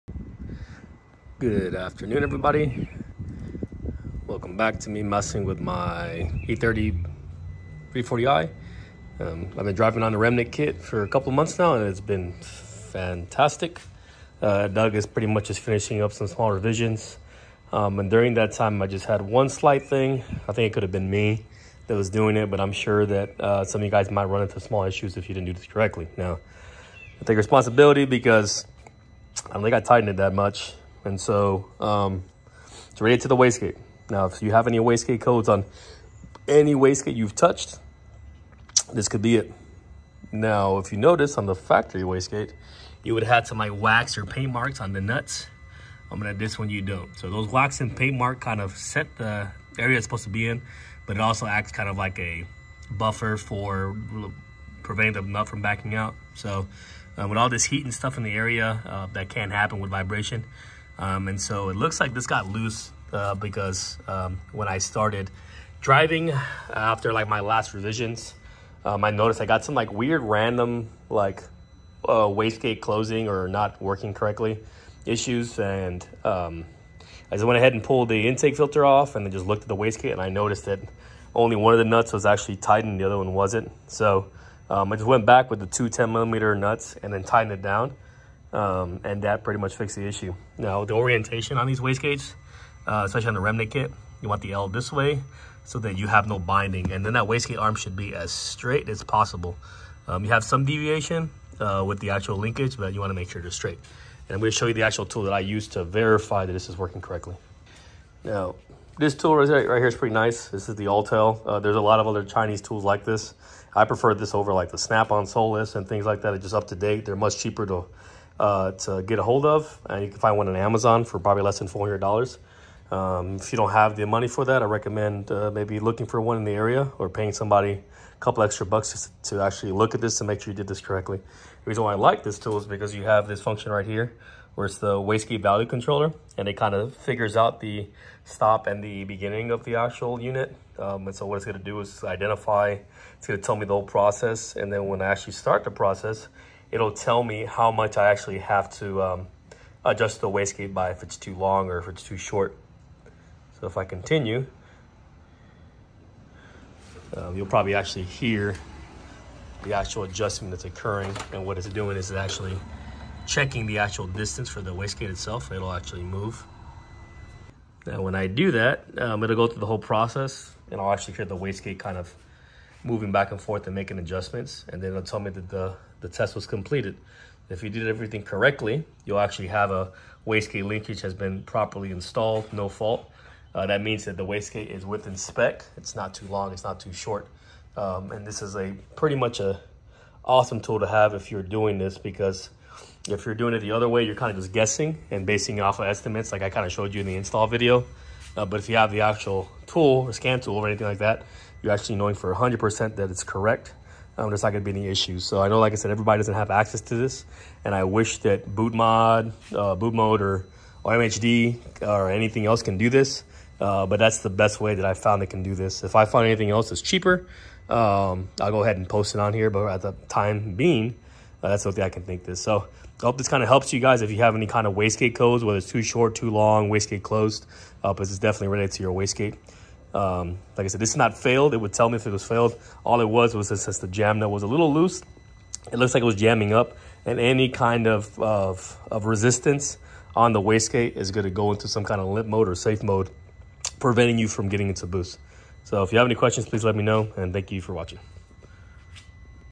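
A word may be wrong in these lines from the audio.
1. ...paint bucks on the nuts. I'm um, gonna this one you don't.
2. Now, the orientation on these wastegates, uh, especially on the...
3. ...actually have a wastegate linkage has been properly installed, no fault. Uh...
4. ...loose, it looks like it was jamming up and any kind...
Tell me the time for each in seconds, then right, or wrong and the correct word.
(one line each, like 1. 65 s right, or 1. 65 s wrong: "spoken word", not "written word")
1. 44 s wrong: "marks", not "bucks"
2. 90 s right
3. 179 s right
4. 234 s right.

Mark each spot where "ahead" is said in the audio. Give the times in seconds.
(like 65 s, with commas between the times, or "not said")
77 s, 218 s.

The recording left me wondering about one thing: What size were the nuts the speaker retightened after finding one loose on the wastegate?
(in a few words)
10 millimeter.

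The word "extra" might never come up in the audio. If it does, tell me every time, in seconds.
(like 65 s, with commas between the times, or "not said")
128 s.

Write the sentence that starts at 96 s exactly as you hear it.
And then that wastegate arm should be as straight as possible.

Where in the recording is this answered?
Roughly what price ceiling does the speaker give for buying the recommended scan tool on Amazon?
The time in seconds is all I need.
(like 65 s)
121 s.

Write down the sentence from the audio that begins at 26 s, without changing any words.
Now, I take responsibility because I don't think I tightened it that much.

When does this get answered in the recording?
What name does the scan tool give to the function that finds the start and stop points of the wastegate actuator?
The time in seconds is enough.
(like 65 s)
134 s.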